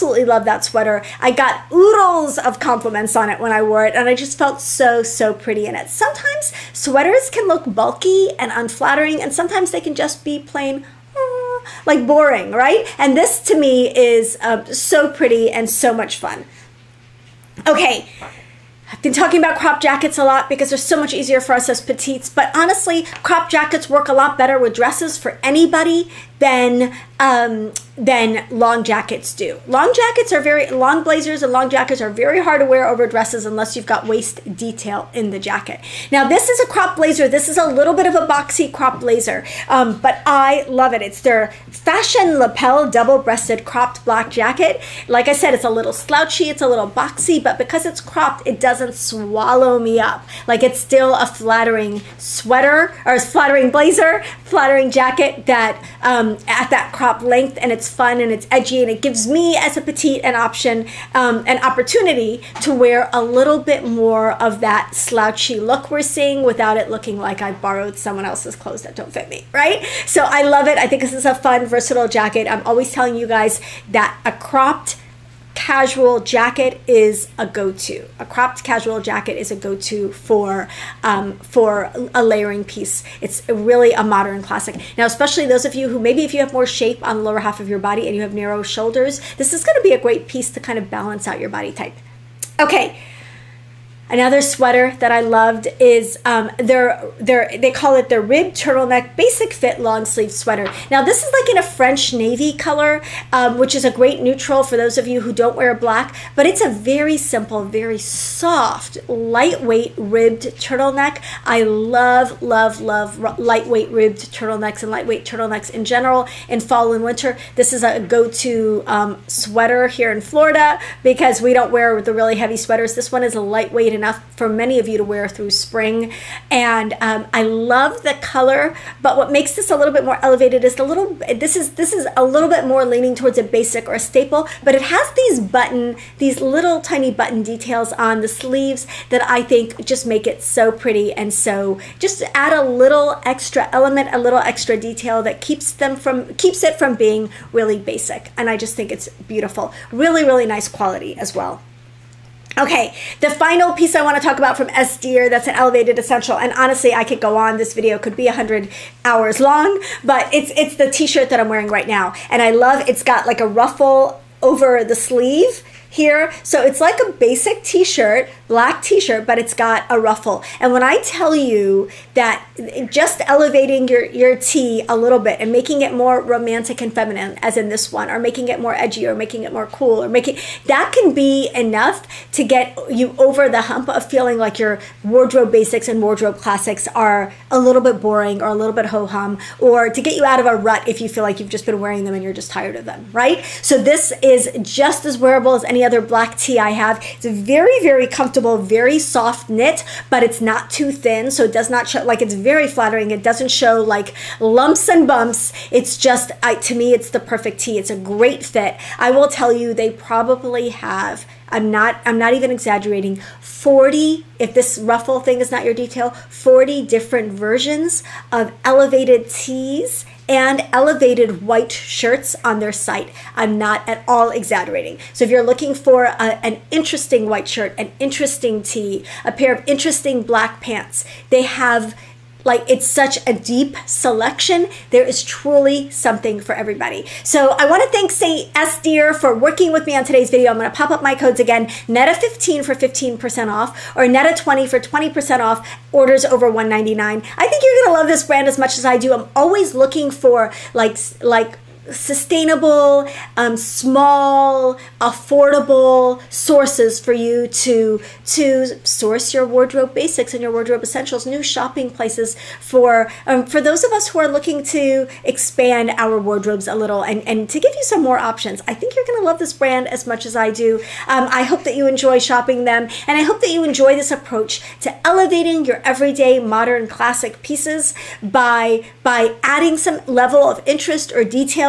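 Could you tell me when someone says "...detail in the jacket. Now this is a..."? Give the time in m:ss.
0:34.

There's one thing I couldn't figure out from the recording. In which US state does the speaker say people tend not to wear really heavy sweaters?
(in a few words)
Florida.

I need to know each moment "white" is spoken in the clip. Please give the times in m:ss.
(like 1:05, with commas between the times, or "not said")
3:41, 3:47.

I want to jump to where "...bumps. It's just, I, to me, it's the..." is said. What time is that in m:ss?
3:25.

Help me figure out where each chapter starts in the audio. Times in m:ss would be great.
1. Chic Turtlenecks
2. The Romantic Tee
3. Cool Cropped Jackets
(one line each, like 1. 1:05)
1. 1:35
2. 2:41
3. 0:21.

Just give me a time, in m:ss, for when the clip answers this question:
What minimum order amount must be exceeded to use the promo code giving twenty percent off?
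4:06.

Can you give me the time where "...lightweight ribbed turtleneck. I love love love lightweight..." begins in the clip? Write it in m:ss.
1:49.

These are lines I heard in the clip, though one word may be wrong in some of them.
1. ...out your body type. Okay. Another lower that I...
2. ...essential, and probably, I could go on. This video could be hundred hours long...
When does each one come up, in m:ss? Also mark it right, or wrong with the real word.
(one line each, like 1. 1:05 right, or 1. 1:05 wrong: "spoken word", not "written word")
1. 1:31 wrong: "sweater", not "lower"
2. 2:35 wrong: "honestly", not "probably".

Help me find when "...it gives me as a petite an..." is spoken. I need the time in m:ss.
0:58.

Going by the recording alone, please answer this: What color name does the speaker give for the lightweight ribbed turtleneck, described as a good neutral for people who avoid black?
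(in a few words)
French navy.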